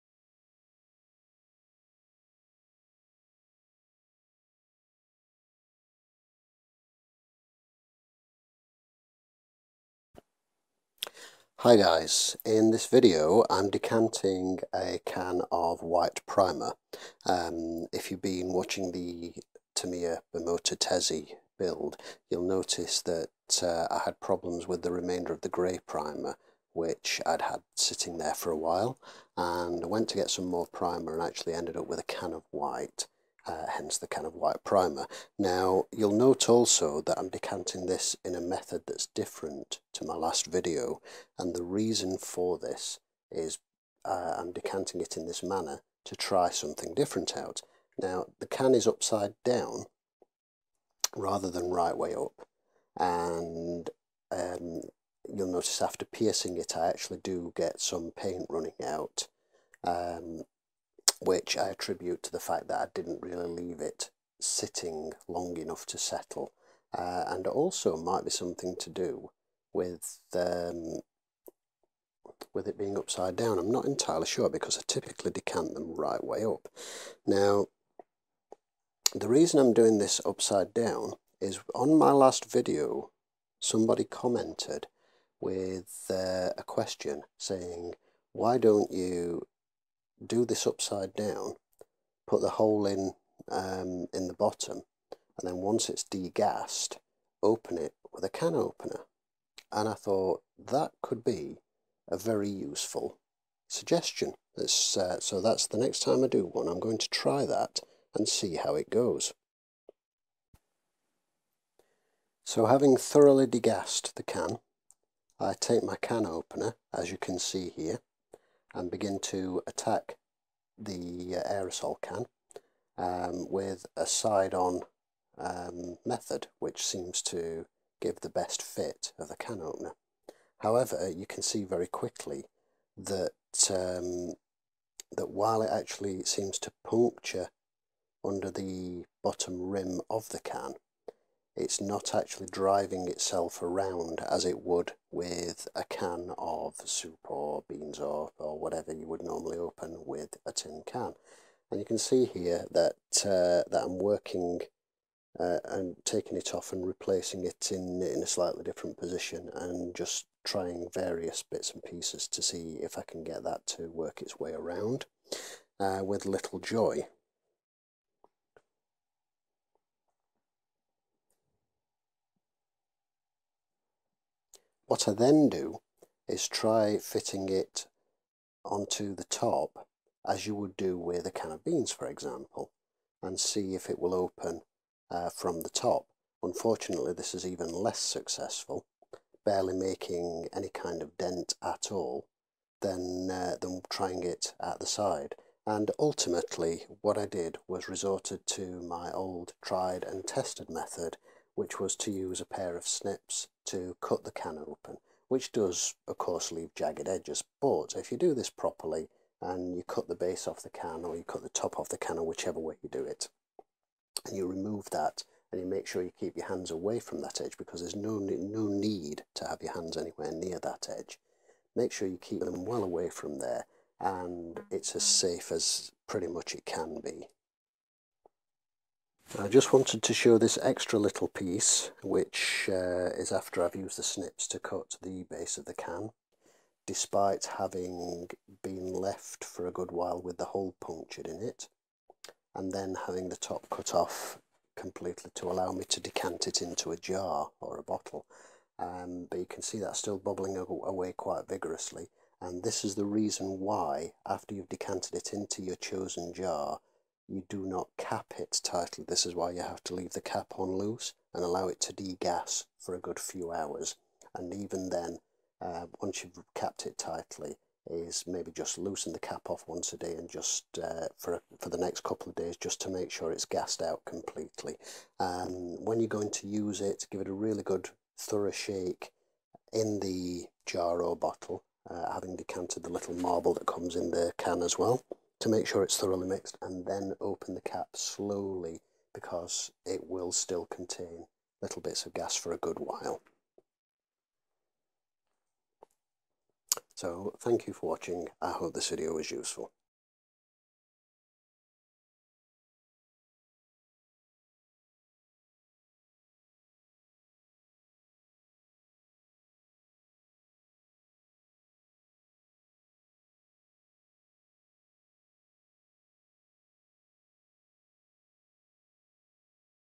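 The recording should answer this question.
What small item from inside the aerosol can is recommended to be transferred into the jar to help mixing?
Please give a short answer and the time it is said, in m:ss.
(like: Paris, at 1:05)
Marble, at 4:43.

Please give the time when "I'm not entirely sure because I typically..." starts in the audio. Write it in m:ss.
1:13.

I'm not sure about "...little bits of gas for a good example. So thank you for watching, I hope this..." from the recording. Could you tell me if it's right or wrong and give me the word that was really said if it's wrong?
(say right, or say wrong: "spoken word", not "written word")
wrong: "while", not "example".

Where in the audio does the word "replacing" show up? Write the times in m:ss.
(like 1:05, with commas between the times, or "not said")
2:36.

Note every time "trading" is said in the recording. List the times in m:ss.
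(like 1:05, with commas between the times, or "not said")
not said.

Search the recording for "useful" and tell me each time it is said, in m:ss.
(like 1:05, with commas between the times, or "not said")
1:42, 4:59.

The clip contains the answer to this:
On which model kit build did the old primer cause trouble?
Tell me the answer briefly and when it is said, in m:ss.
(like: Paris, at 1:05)
Tamiya Bimota Tesi, at 0:19.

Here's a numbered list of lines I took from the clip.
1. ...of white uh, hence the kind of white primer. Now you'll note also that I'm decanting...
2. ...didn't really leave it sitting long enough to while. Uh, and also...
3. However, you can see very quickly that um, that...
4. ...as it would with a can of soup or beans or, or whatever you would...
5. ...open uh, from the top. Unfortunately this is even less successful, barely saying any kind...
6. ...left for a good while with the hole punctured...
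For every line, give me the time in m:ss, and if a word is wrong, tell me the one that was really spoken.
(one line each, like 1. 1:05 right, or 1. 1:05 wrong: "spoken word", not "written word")
1. 0:32 right
2. 1:02 wrong: "settle", not "while"
3. 2:10 right
4. 2:24 right
5. 3:04 wrong: "making", not "saying"
6. 3:58 right.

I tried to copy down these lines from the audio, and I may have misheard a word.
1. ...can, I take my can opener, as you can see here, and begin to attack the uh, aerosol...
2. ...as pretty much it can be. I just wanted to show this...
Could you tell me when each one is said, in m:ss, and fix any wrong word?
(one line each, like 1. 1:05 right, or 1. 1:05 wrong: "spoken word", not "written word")
1. 1:54 right
2. 3:45 right.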